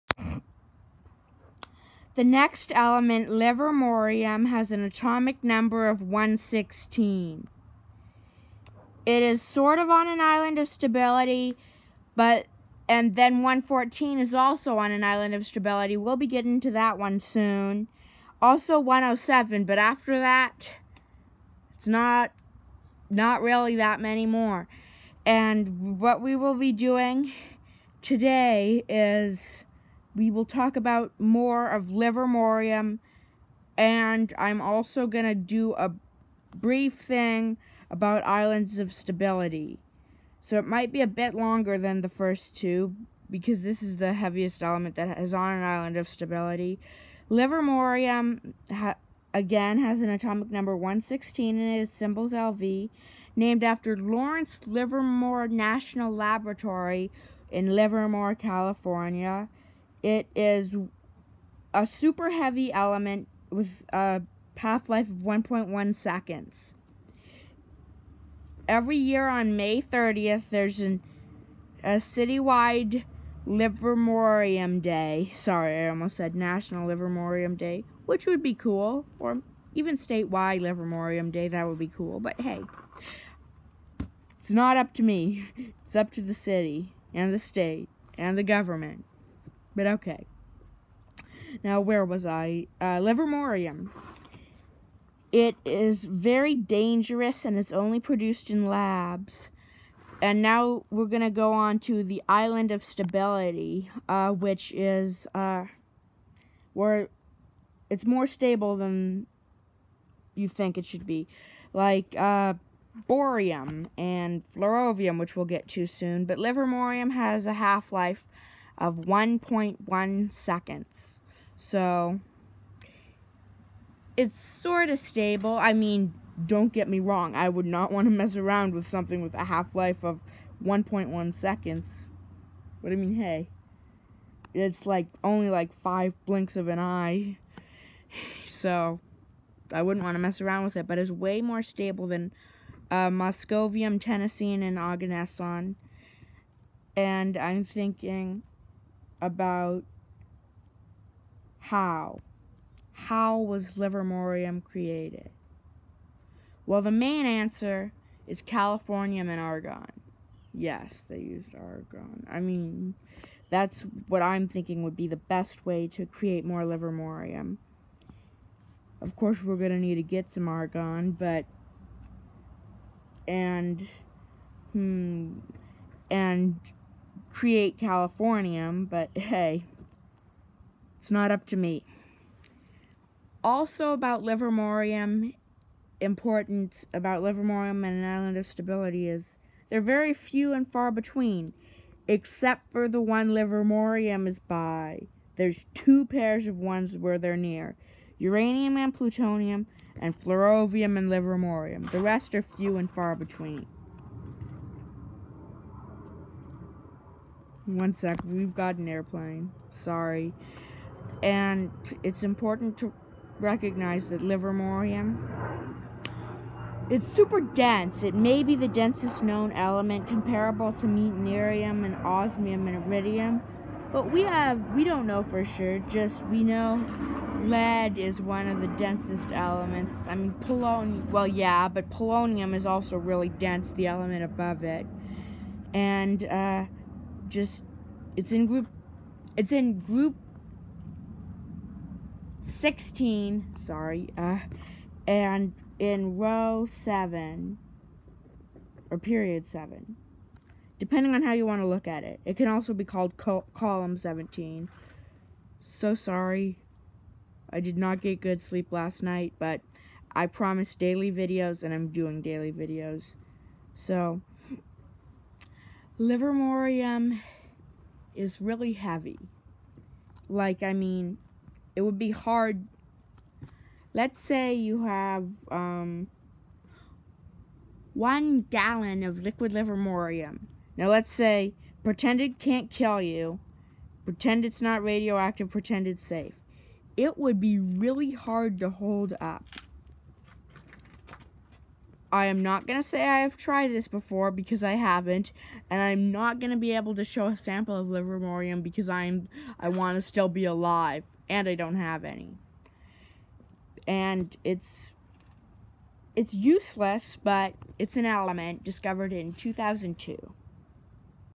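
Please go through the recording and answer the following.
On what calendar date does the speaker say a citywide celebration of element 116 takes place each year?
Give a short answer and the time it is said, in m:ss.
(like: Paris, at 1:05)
May 30th, at 1:09.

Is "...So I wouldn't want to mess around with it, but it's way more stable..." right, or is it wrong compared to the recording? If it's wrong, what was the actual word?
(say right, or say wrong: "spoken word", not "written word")
right.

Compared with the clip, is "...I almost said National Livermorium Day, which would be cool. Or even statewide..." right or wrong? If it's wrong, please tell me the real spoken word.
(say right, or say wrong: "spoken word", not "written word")
right.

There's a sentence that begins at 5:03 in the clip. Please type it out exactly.
And it's it's useless, but it's an element discovered in 2002.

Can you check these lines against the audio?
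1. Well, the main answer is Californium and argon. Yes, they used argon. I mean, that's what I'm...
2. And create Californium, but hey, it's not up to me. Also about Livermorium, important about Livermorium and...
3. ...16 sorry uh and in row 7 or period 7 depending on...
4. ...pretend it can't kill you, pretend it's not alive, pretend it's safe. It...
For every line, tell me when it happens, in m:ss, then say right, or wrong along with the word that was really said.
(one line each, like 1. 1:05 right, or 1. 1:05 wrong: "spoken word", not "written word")
1. 2:36 right
2. 2:56 right
3. 4:02 right
4. 4:41 wrong: "radioactive", not "alive".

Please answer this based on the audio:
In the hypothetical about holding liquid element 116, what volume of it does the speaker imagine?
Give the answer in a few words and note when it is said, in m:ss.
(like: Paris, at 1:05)
one gallon, at 4:37.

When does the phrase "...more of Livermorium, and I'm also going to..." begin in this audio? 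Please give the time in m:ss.
0:31.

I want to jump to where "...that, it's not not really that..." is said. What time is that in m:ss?
0:20.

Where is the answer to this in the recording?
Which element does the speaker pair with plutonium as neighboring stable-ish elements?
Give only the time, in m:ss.
3:18.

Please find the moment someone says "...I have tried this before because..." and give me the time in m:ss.
4:53.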